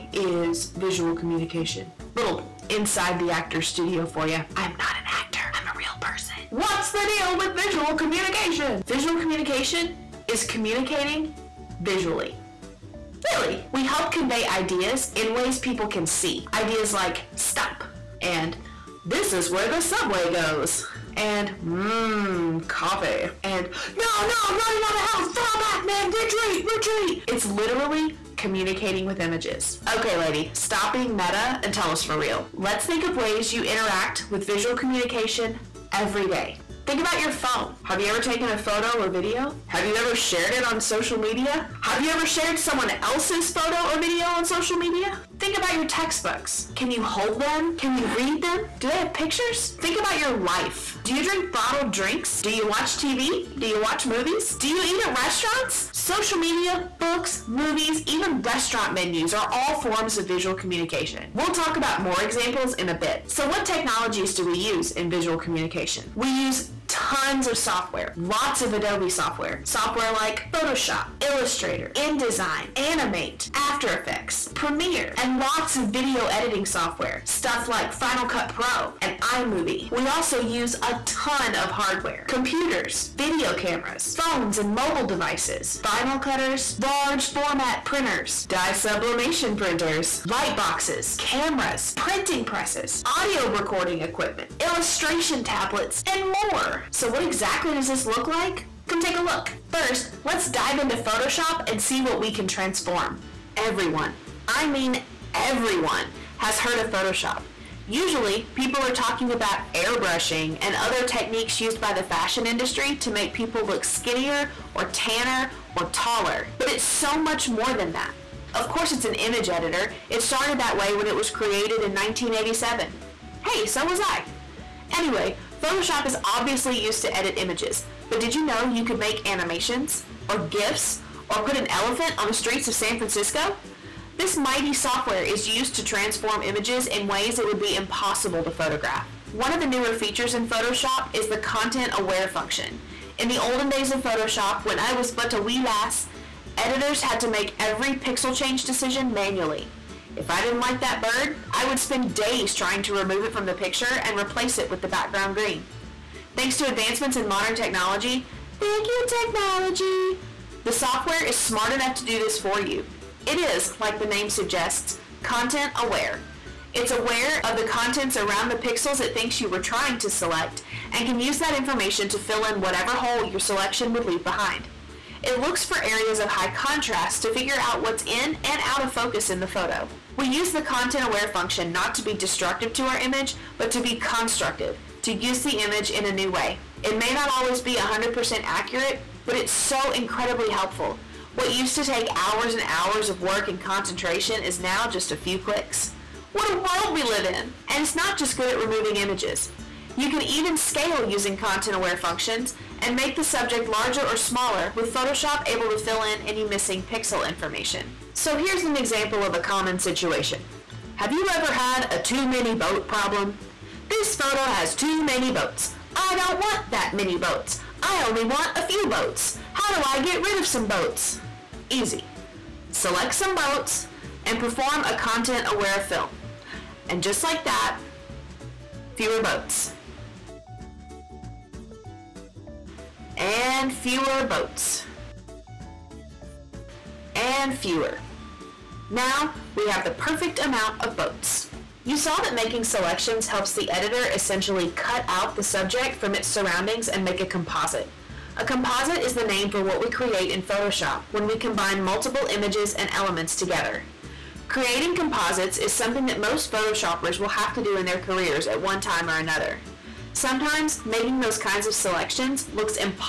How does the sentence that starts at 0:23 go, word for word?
And no, no, running out of health, fall back, man, retreat, retreat.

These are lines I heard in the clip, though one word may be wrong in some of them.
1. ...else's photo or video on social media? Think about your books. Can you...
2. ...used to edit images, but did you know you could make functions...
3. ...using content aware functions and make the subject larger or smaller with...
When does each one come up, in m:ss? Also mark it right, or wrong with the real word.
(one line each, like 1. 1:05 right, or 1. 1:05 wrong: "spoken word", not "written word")
1. 0:43 wrong: "textbooks", not "books"
2. 2:06 wrong: "animations", not "functions"
3. 3:21 right.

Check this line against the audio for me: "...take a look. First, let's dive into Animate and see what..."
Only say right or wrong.
wrong.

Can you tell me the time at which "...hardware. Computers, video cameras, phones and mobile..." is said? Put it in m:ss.
1:21.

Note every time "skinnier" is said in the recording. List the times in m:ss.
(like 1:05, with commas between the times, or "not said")
1:53.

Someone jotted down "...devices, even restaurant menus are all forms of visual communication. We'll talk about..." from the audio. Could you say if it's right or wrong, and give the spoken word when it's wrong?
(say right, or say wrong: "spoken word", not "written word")
wrong: "movies", not "devices".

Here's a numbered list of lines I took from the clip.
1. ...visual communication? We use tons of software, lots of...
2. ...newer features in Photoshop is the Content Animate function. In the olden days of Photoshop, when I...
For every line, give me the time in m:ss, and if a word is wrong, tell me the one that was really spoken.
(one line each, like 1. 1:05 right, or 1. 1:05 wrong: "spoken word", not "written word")
1. 1:05 right
2. 2:19 wrong: "Aware", not "Animate".